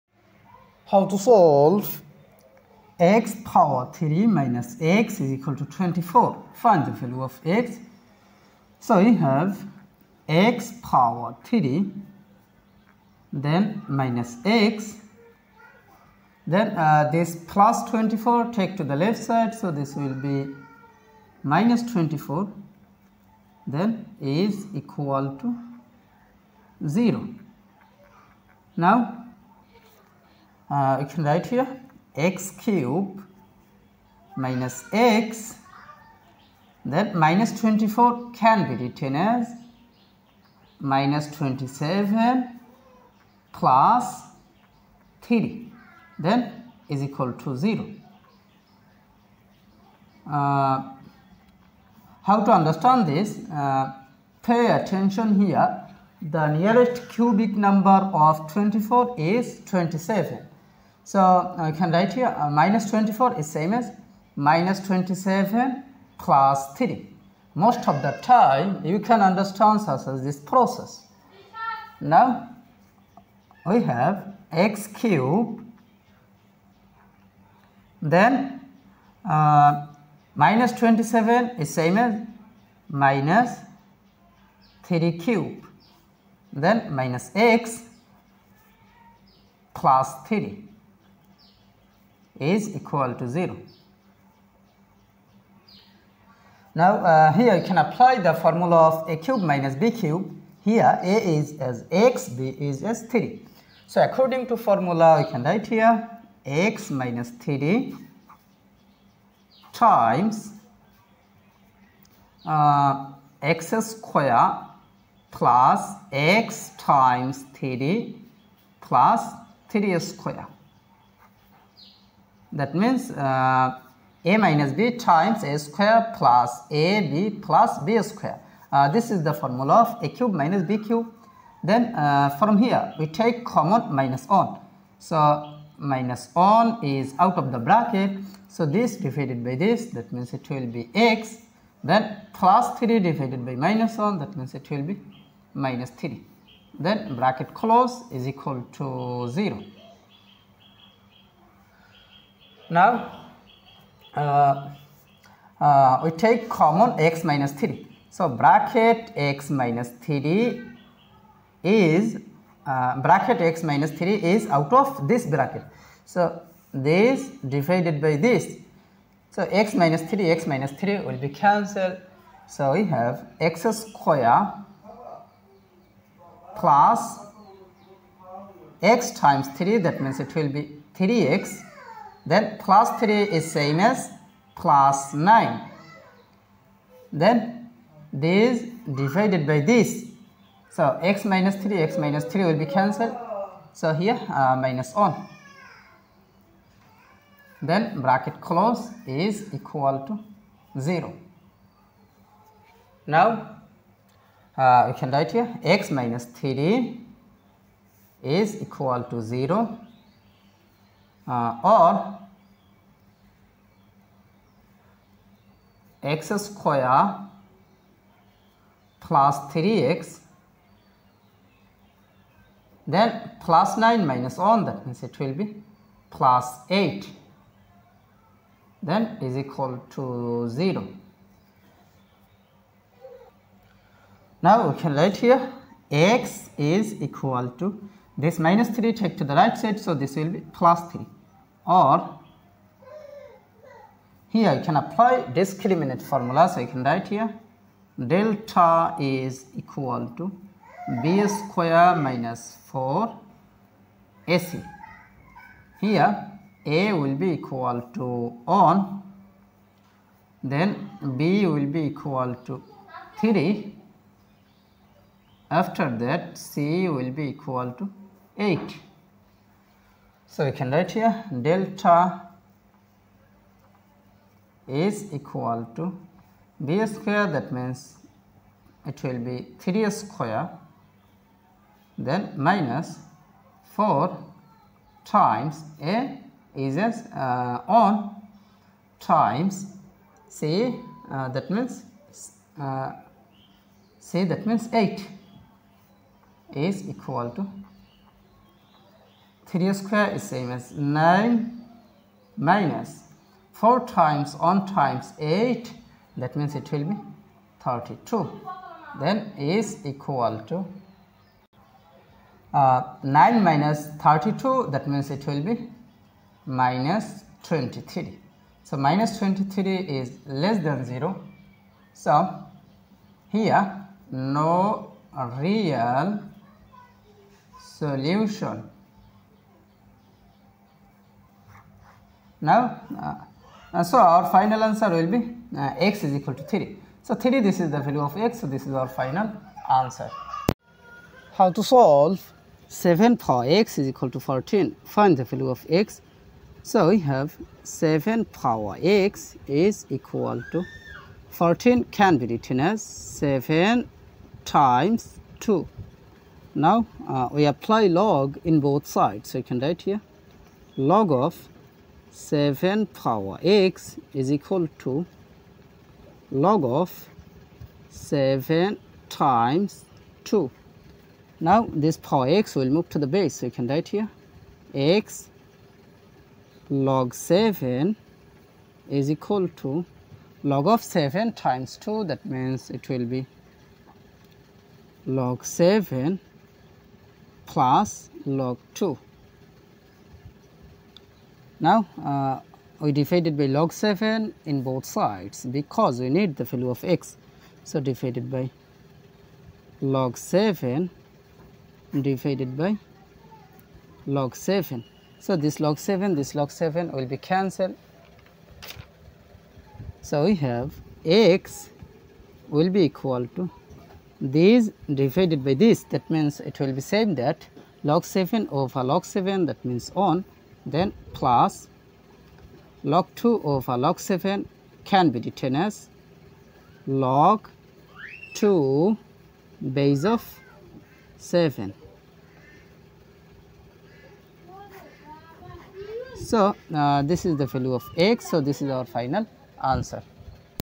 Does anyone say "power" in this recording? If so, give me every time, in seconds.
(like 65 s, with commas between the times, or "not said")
3 s, 10 s, 343 s, 348 s, 362 s, 371 s.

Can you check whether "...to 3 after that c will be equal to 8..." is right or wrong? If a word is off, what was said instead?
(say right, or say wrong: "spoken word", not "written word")
right.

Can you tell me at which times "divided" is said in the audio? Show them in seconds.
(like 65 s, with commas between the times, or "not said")
138 s, 142 s, 167 s, 188 s, 392 s, 397 s, 402 s, 414 s.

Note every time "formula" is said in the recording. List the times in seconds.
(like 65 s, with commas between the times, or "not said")
98 s, 104 s, 129 s, 246 s.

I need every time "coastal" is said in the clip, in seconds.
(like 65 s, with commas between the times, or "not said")
not said.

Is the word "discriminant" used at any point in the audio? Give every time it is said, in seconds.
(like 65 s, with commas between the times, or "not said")
245 s.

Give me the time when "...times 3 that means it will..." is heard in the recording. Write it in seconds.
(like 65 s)
179 s.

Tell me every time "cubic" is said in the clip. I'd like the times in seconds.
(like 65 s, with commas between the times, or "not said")
57 s.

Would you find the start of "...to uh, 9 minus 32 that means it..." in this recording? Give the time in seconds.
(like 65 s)
310 s.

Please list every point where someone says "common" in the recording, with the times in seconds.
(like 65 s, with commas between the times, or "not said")
133 s, 156 s.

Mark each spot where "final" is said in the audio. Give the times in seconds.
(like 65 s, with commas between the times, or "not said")
334 s, 338 s, 438 s.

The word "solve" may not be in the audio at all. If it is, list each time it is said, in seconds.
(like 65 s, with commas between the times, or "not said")
1 s, 341 s.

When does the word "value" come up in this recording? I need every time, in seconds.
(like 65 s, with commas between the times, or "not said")
6 s, 337 s, 345 s, 396 s, 437 s.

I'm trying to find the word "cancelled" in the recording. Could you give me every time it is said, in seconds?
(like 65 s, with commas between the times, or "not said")
171 s, 192 s, 407 s.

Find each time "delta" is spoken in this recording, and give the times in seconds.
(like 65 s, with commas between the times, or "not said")
248 s, 271 s.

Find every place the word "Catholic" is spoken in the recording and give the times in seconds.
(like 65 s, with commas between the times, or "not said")
not said.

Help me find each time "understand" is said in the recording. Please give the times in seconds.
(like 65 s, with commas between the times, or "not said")
52 s, 69 s.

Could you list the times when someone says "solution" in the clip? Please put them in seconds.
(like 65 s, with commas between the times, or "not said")
327 s.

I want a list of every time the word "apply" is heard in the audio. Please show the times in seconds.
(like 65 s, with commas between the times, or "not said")
97 s, 244 s, 357 s.